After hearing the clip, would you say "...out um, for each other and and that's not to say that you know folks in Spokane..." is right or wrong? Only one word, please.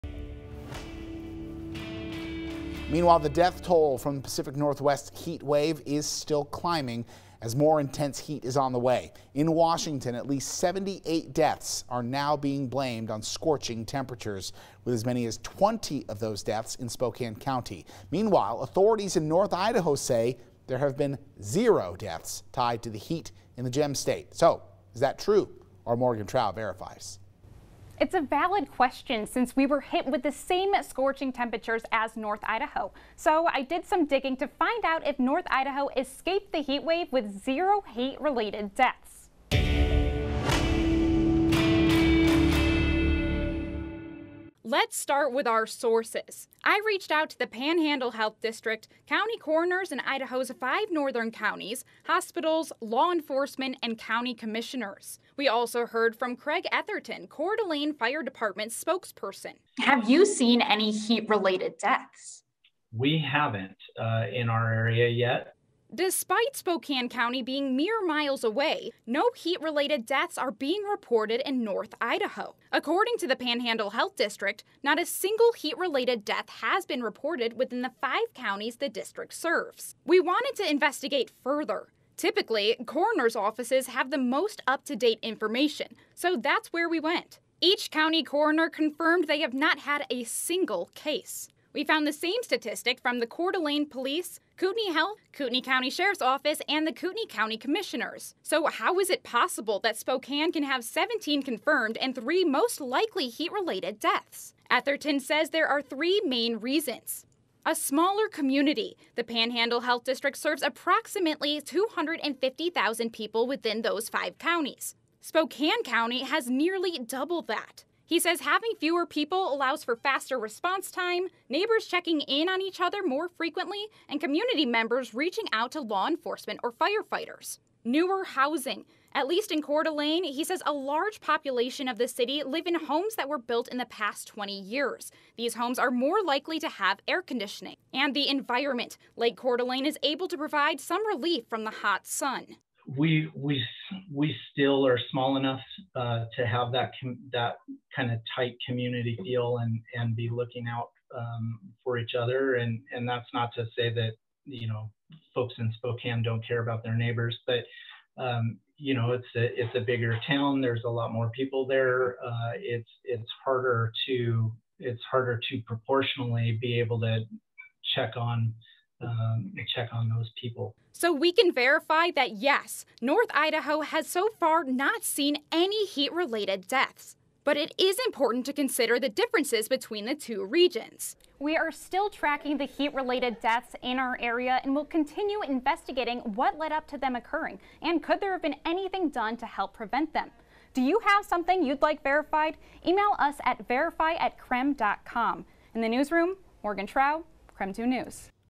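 right.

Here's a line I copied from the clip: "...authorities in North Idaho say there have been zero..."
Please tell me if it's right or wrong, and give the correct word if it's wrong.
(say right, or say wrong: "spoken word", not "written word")
right.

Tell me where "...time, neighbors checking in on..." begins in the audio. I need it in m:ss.
2:00.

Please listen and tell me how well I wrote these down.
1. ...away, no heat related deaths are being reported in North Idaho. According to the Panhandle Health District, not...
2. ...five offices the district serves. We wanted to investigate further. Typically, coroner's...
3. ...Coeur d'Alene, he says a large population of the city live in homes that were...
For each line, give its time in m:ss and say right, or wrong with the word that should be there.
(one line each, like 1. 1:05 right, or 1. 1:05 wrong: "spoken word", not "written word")
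1. 1:08 right
2. 1:17 wrong: "counties", not "offices"
3. 2:09 right.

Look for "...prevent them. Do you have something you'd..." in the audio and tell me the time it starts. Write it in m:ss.
3:09.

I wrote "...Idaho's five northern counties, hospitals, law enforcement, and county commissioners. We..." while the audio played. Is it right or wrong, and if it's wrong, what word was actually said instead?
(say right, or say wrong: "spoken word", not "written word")
right.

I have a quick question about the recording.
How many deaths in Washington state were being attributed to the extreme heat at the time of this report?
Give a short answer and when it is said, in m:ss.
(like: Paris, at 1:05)
78, at 0:10.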